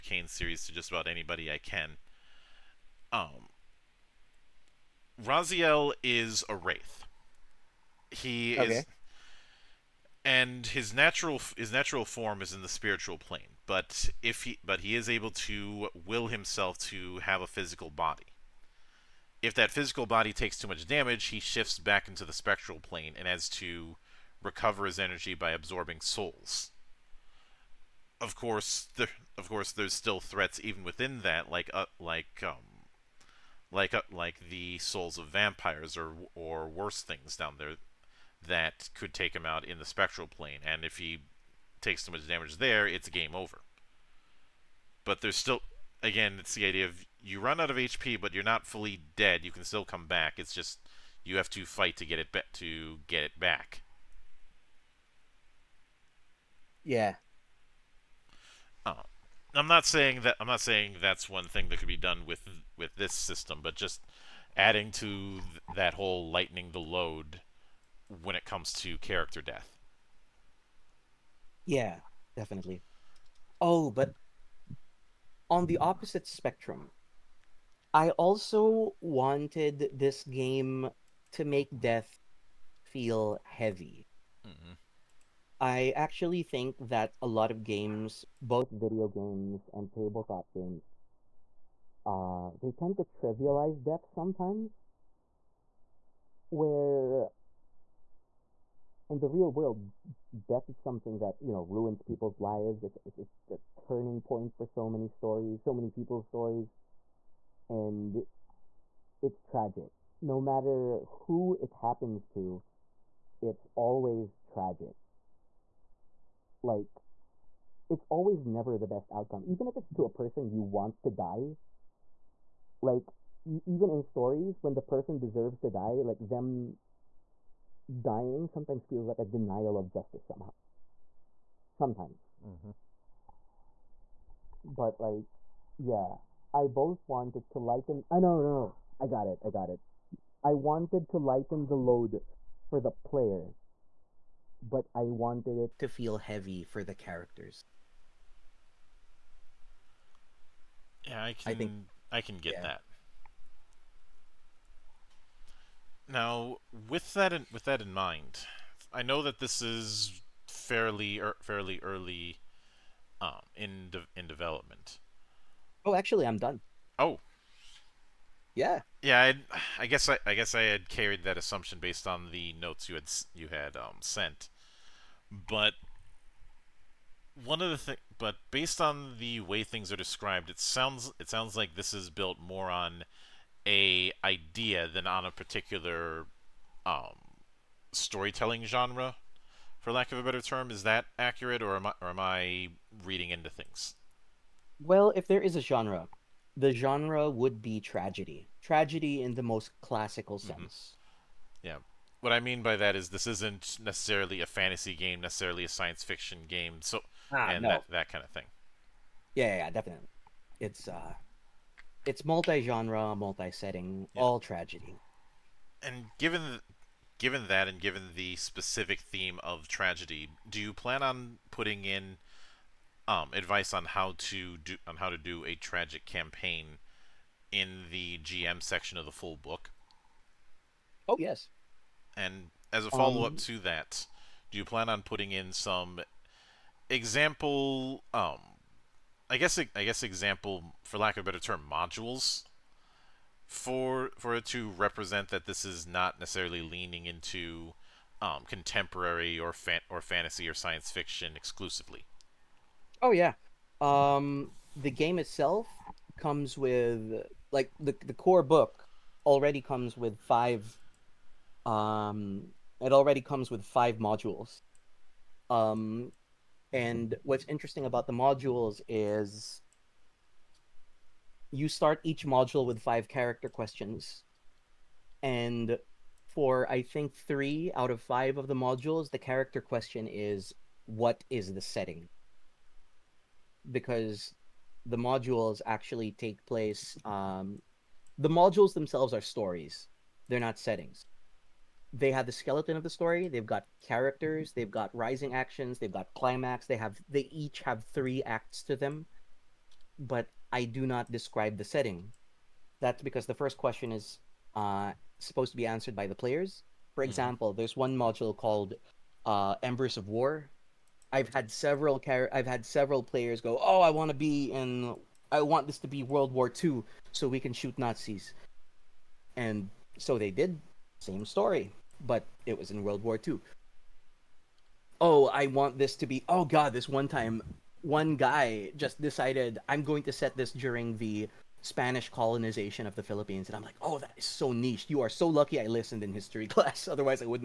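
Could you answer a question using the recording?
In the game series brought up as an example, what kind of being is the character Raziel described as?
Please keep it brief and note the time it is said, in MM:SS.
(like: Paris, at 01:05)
A wraith, at 00:06.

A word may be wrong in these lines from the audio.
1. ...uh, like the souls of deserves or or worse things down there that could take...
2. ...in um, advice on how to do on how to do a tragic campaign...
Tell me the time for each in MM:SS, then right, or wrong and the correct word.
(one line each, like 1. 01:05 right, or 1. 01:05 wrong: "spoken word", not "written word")
1. 00:33 wrong: "vampires", not "deserves"
2. 03:41 right.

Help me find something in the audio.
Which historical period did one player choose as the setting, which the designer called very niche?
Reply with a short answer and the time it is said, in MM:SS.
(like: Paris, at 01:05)
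Spanish colonization of the Philippines, at 05:31.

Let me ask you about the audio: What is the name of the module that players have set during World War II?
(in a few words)
Embers of War.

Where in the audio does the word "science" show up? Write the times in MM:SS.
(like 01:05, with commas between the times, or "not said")
03:25, 04:10.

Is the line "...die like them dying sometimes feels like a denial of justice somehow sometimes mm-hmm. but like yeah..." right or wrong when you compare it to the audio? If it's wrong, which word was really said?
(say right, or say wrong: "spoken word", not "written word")
right.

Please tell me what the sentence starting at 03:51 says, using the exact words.
Oh yes, and as a follow up um, to that, do you plan on putting in some example?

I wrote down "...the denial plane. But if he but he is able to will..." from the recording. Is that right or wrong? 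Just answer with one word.
wrong.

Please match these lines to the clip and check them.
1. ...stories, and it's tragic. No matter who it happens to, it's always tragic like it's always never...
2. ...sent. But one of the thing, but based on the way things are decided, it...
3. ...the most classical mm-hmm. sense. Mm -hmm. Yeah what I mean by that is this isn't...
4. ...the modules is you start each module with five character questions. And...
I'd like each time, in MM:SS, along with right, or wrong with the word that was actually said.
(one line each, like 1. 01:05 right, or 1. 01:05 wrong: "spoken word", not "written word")
1. 01:46 right
2. 02:54 wrong: "described", not "decided"
3. 03:19 right
4. 04:28 right.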